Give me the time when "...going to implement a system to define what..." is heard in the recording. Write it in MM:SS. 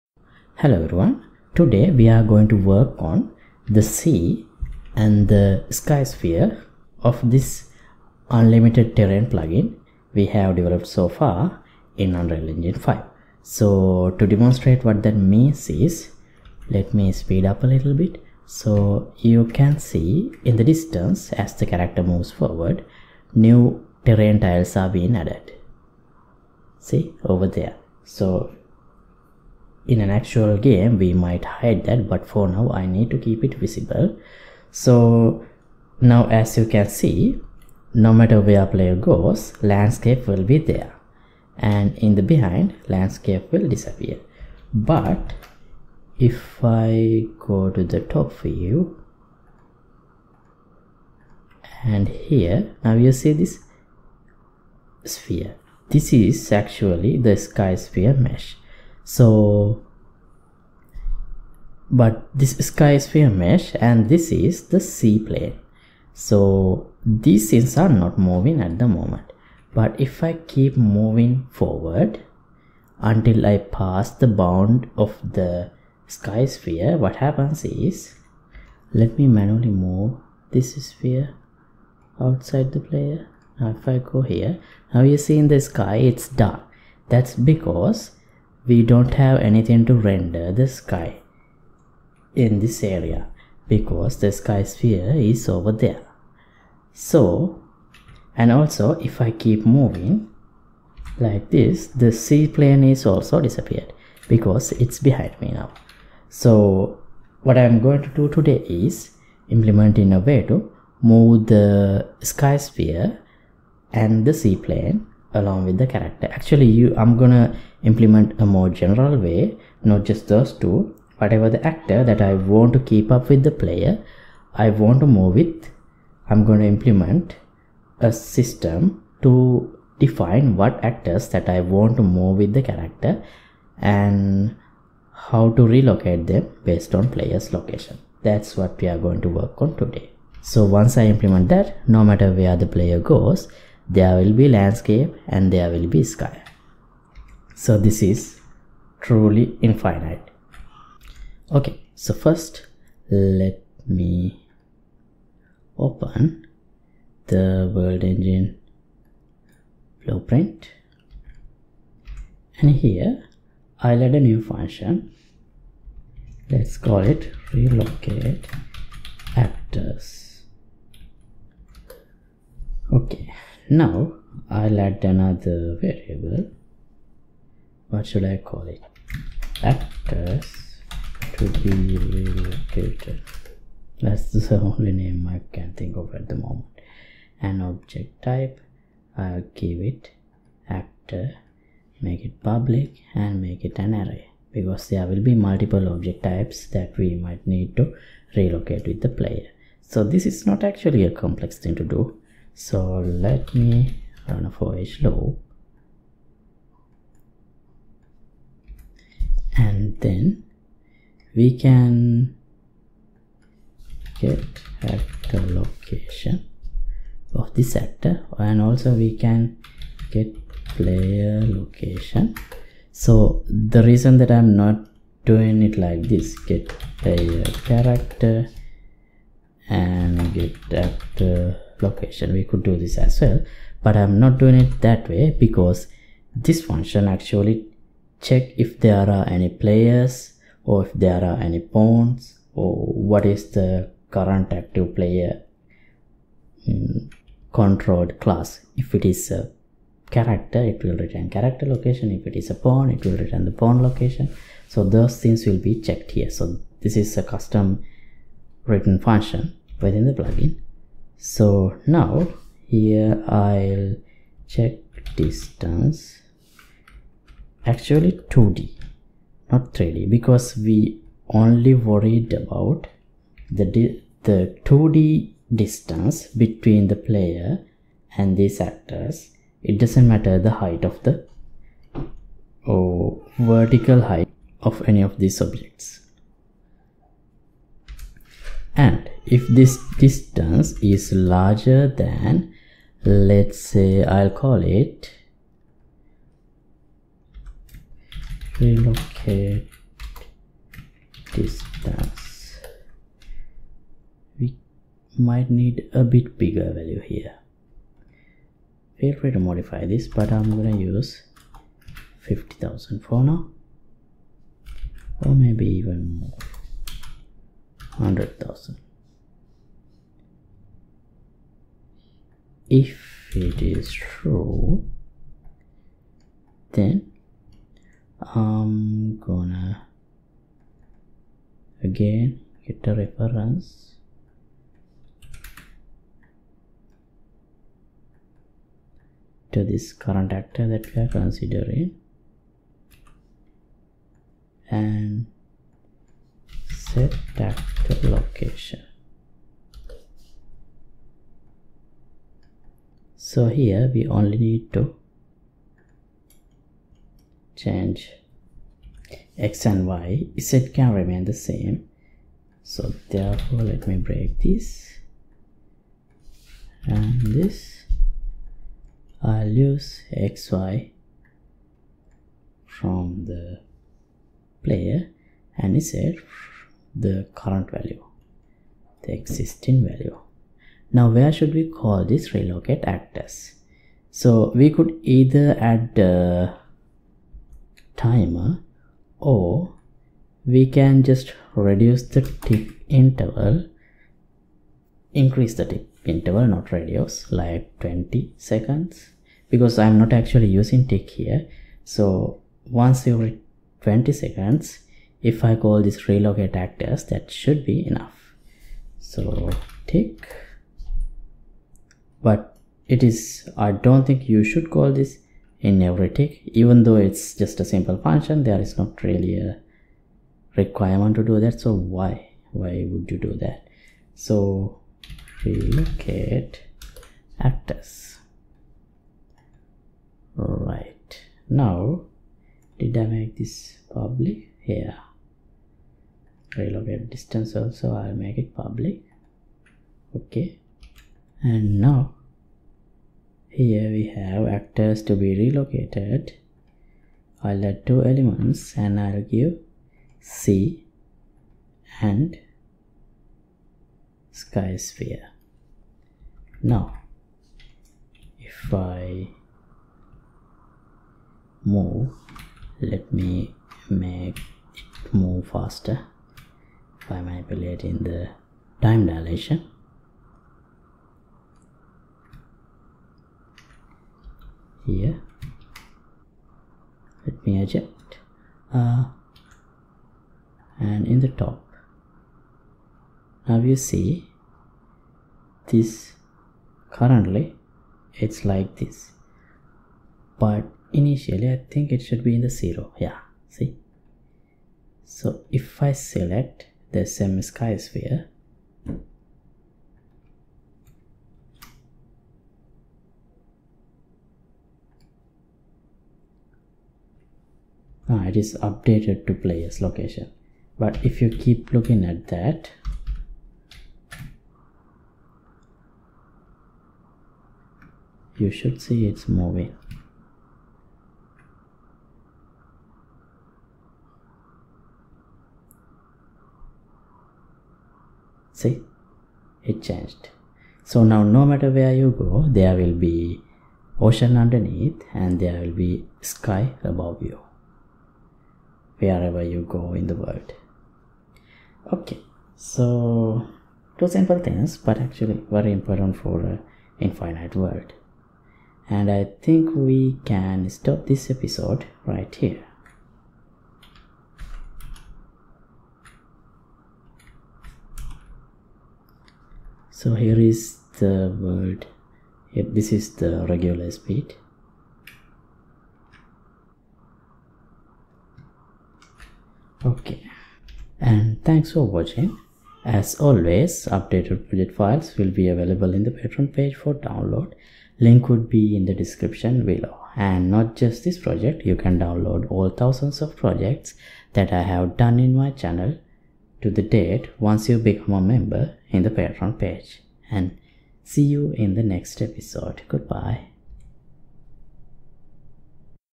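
02:06.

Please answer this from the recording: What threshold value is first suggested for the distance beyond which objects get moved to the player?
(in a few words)
50,000.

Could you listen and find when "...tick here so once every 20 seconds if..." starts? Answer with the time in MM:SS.
06:40.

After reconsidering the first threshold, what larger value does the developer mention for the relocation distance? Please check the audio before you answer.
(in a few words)
100,000.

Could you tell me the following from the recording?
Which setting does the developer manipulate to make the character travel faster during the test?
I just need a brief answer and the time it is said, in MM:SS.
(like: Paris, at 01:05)
time dilation, at 07:48.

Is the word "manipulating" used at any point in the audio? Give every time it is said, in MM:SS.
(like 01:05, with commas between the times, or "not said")
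07:47.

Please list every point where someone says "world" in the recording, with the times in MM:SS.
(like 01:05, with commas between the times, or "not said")
02:37, 09:00, 09:07.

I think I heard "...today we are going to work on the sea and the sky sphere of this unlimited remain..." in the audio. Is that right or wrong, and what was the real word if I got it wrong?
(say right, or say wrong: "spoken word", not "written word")
wrong: "terrain", not "remain".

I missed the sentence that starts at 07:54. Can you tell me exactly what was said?
Here, let me adjust uh, and in the top.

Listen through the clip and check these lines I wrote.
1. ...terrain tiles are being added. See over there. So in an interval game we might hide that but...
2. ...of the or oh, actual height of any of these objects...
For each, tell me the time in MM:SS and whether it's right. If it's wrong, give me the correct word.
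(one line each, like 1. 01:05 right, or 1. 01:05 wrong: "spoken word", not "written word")
1. 00:24 wrong: "actual", not "interval"
2. 04:40 wrong: "vertical", not "actual".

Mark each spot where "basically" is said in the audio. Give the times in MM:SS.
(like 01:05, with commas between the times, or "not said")
not said.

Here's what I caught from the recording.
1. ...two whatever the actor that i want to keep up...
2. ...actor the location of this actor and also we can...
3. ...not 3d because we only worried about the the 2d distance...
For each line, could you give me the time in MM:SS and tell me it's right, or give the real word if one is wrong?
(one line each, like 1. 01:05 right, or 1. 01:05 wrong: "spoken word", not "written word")
1. 02:00 right
2. 03:34 right
3. 04:29 right.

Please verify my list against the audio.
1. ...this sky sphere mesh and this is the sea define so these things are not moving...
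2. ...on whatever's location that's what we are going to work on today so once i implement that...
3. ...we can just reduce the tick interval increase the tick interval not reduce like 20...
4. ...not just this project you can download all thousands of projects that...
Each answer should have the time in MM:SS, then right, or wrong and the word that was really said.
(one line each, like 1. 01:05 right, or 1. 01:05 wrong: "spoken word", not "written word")
1. 01:02 wrong: "plane", not "define"
2. 02:16 wrong: "player", not "whatever"
3. 06:30 right
4. 09:40 right.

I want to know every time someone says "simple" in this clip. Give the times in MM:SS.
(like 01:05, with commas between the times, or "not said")
06:57, 09:04.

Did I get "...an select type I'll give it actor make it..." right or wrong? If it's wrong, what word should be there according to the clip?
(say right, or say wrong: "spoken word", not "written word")
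wrong: "object", not "select".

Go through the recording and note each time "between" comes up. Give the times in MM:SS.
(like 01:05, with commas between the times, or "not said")
04:36.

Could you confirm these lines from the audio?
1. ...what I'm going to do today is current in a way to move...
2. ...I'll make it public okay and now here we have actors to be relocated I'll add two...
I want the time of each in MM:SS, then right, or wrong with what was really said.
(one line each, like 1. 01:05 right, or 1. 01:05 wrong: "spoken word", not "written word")
1. 01:47 wrong: "implement", not "current"
2. 07:17 right.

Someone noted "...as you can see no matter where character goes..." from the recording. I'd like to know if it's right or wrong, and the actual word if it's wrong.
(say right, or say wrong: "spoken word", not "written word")
wrong: "player", not "character".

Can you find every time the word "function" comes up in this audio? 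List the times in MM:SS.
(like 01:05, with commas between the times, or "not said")
02:44, 03:56, 04:18, 06:57.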